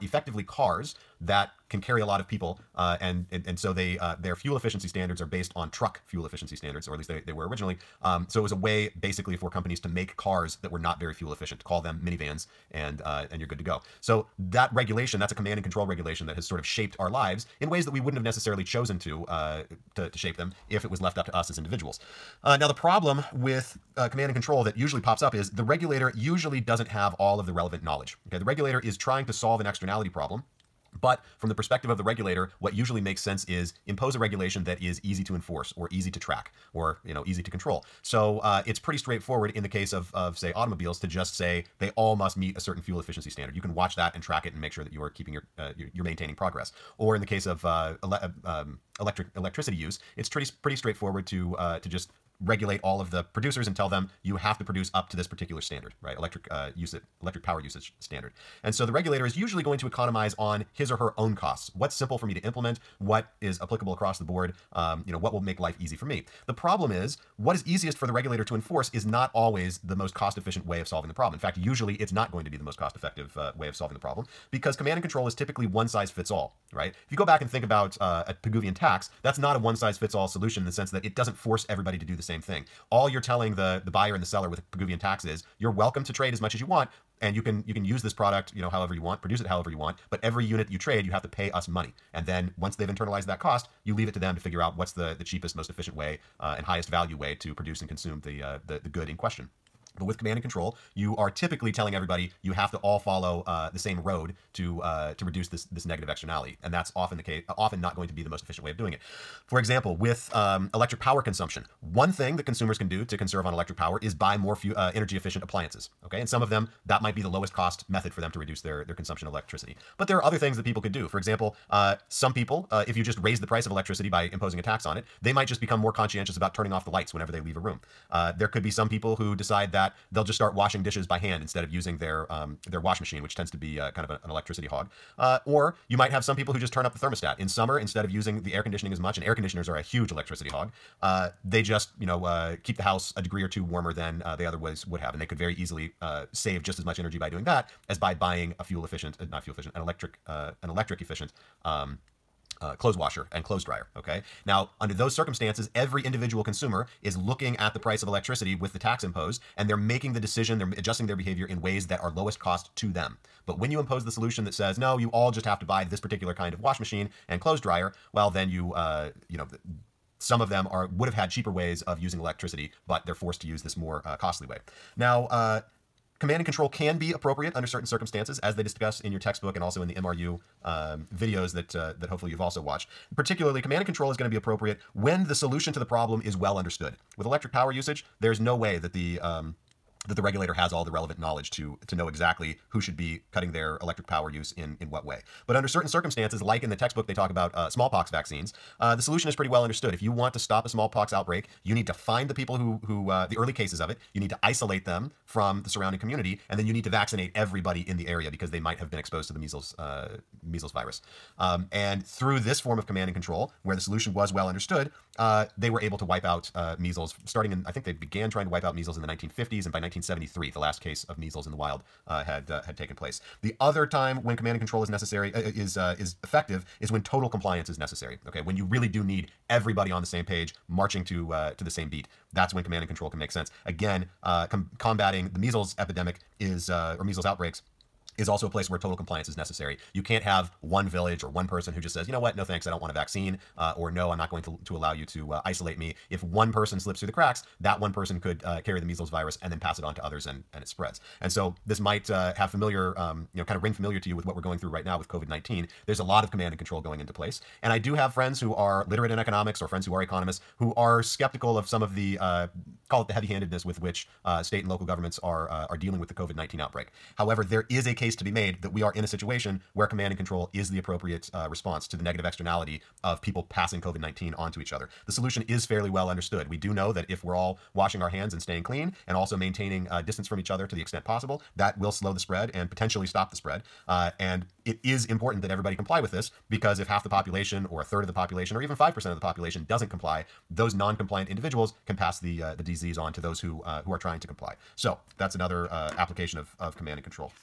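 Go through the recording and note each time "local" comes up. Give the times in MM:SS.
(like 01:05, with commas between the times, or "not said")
04:24.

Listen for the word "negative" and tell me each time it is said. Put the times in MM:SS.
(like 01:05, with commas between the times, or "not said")
01:45, 04:32.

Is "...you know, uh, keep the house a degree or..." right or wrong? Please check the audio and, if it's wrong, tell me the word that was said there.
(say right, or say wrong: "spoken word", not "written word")
right.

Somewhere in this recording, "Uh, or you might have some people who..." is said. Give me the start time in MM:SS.
02:15.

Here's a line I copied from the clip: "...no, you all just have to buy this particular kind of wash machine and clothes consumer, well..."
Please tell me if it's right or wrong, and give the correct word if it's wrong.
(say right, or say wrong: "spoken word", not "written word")
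wrong: "dryer", not "consumer".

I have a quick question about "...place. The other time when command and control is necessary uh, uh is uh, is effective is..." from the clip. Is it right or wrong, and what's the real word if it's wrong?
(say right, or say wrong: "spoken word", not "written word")
right.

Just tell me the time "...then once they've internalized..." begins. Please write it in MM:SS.
01:32.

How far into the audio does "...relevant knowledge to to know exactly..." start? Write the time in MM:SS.
03:10.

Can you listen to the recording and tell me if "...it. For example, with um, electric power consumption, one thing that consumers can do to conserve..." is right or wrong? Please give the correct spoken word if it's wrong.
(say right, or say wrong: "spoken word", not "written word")
right.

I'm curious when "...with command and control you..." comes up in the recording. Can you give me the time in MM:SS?
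01:40.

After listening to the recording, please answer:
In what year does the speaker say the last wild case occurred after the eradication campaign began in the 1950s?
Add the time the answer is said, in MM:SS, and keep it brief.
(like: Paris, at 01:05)
1973, at 03:39.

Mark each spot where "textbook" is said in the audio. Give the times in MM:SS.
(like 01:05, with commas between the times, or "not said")
02:59, 03:16.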